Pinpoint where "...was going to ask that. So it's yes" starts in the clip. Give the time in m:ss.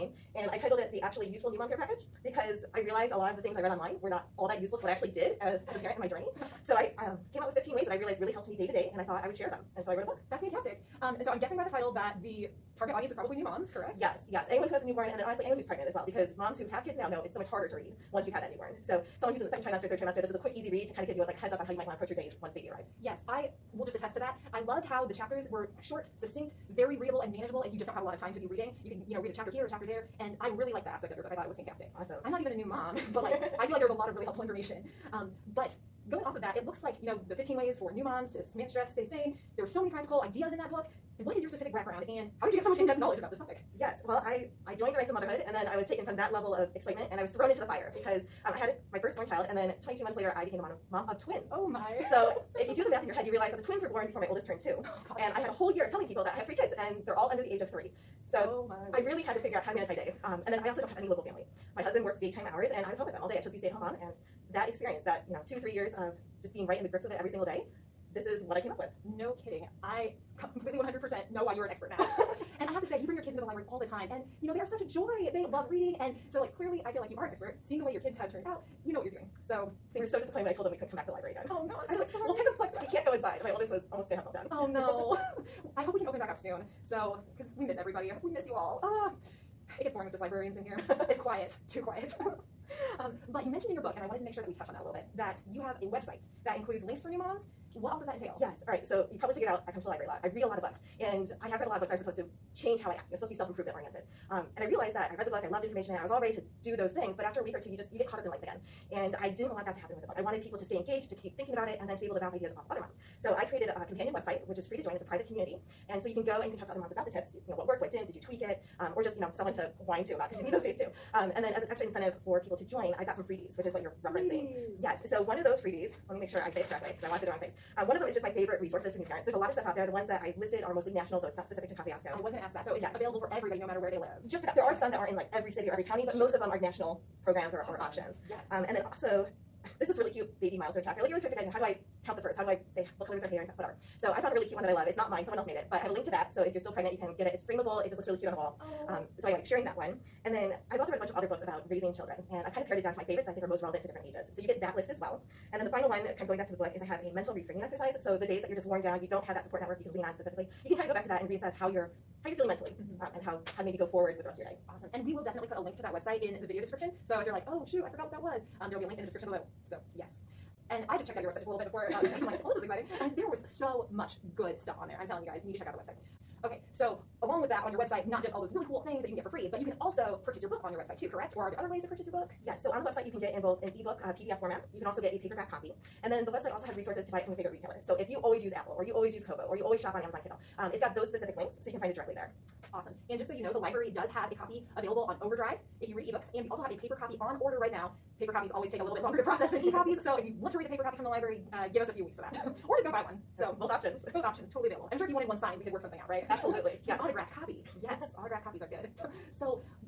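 2:12.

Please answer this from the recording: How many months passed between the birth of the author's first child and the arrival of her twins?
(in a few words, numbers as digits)
22 months.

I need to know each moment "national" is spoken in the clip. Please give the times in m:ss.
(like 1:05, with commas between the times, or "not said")
2:10, 2:16.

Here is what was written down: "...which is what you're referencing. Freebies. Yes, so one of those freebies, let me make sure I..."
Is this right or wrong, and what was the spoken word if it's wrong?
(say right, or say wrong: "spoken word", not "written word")
right.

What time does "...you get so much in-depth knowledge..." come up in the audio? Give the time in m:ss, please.
0:42.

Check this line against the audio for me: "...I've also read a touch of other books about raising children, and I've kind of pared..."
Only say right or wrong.
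wrong.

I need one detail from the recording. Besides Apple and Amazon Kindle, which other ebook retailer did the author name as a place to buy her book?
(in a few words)
Kobo.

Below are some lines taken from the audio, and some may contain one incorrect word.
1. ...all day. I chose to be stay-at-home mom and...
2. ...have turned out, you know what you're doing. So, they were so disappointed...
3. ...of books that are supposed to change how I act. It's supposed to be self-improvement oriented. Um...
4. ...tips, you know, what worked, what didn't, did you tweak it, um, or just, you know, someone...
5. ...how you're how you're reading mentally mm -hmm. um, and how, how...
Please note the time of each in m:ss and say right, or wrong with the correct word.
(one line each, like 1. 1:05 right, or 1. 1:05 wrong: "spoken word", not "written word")
1. 1:03 right
2. 1:18 right
3. 1:41 right
4. 1:57 right
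5. 2:41 wrong: "feeling", not "reading".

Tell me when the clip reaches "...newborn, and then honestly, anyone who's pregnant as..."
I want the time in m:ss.
0:14.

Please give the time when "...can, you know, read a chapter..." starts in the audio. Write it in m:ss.
0:28.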